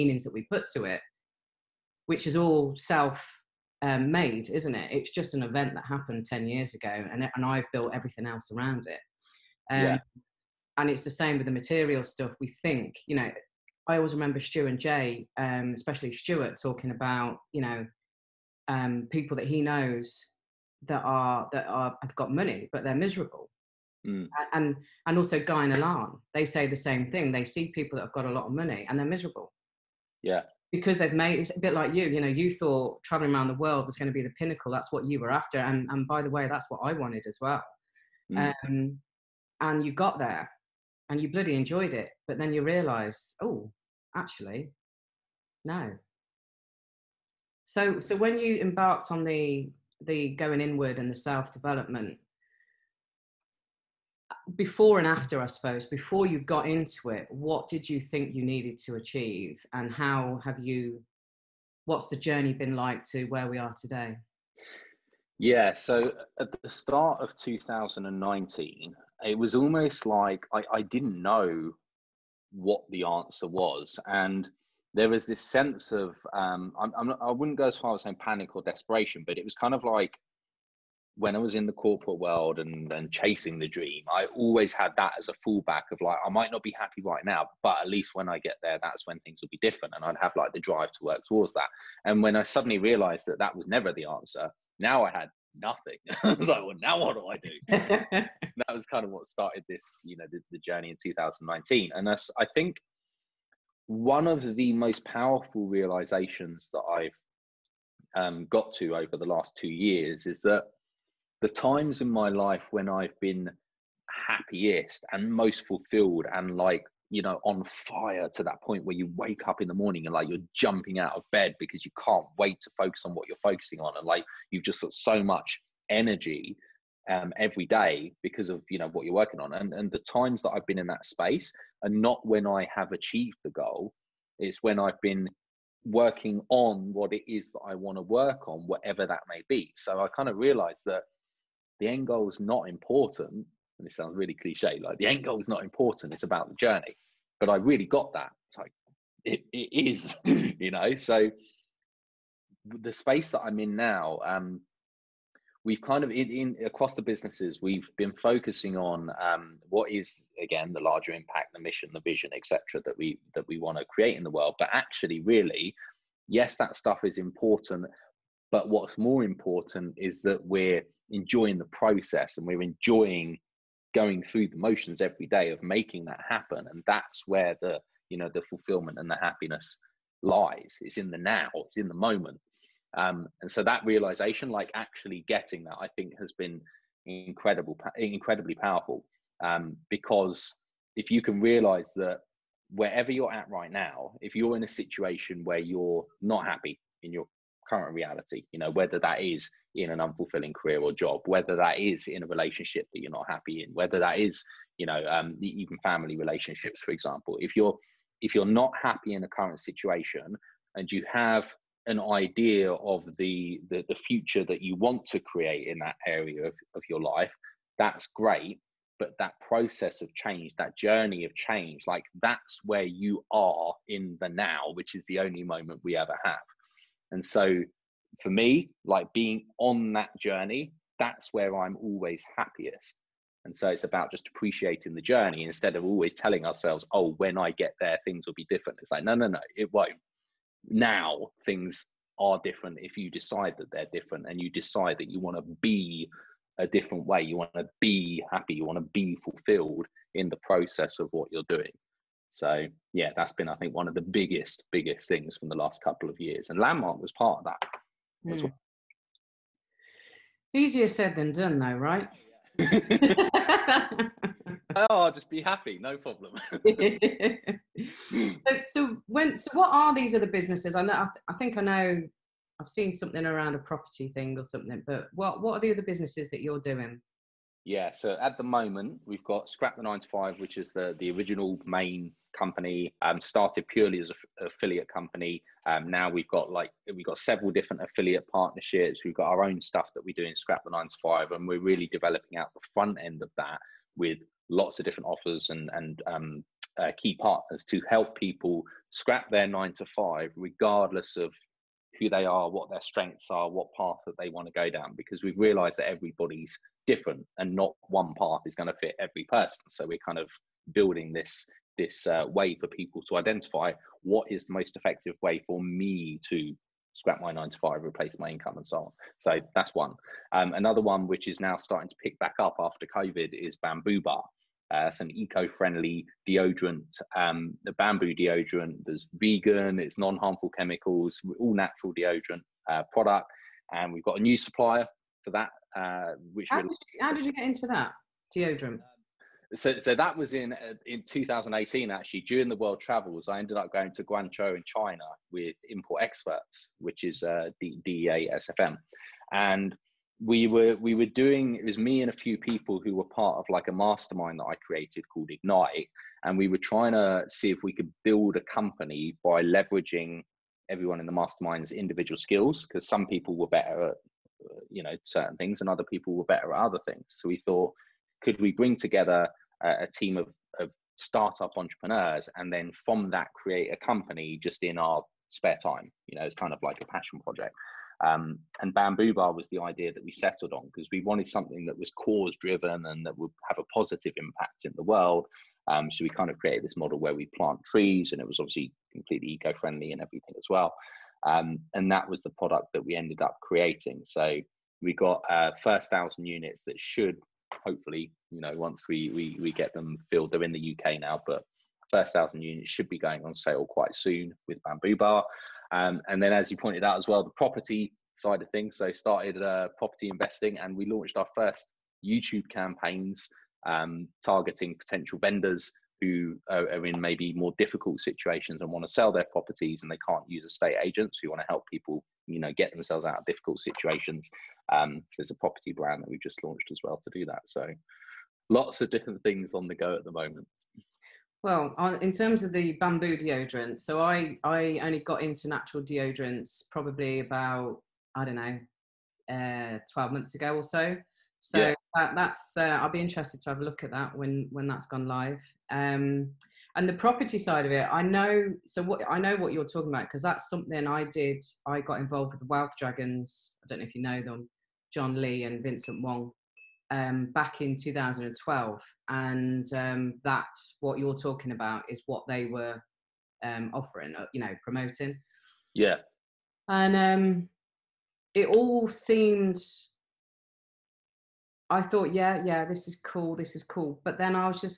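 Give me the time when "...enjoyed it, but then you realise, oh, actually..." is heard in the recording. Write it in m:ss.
0:41.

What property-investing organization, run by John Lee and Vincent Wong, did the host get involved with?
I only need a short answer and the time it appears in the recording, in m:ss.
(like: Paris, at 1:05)
Wealth Dragons, at 7:32.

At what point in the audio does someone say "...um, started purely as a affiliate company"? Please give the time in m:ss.
4:43.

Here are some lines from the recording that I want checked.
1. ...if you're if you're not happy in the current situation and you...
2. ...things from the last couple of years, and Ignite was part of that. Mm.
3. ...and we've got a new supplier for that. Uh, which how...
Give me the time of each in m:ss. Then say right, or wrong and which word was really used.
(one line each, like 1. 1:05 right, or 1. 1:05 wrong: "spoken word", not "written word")
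1. 3:27 right
2. 4:15 wrong: "Landmark", not "Ignite"
3. 5:33 right.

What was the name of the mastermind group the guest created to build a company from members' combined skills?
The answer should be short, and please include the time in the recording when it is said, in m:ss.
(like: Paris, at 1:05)
Ignite, at 5:55.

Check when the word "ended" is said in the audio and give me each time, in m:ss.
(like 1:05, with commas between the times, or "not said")
5:43, 6:32.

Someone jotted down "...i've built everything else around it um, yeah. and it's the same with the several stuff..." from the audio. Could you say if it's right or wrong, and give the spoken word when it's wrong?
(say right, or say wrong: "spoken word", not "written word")
wrong: "material", not "several".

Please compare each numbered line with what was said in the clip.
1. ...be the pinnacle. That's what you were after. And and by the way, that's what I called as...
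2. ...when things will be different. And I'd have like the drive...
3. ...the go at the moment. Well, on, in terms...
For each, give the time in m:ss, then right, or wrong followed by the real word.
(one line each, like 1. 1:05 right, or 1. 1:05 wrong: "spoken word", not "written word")
1. 0:34 wrong: "wanted", not "called"
2. 1:29 right
3. 7:09 right.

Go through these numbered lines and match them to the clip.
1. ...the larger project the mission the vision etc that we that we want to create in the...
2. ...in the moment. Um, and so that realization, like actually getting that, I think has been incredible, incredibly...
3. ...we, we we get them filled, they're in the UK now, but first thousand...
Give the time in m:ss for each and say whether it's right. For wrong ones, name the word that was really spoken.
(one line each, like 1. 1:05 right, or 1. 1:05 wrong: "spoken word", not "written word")
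1. 2:40 wrong: "impact", not "project"
2. 3:01 right
3. 6:38 right.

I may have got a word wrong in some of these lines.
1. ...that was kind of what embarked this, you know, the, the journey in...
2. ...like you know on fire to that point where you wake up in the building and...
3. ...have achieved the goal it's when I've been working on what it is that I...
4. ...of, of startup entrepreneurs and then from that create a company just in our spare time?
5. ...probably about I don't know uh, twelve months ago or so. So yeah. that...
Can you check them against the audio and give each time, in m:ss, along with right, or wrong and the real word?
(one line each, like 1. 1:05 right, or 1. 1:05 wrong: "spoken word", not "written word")
1. 1:38 wrong: "started", not "embarked"
2. 1:56 wrong: "morning", not "building"
3. 2:12 right
4. 6:10 right
5. 7:16 right.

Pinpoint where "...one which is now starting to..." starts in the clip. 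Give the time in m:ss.
5:20.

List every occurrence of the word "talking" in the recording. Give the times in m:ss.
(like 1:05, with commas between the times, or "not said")
0:16, 7:29, 7:41.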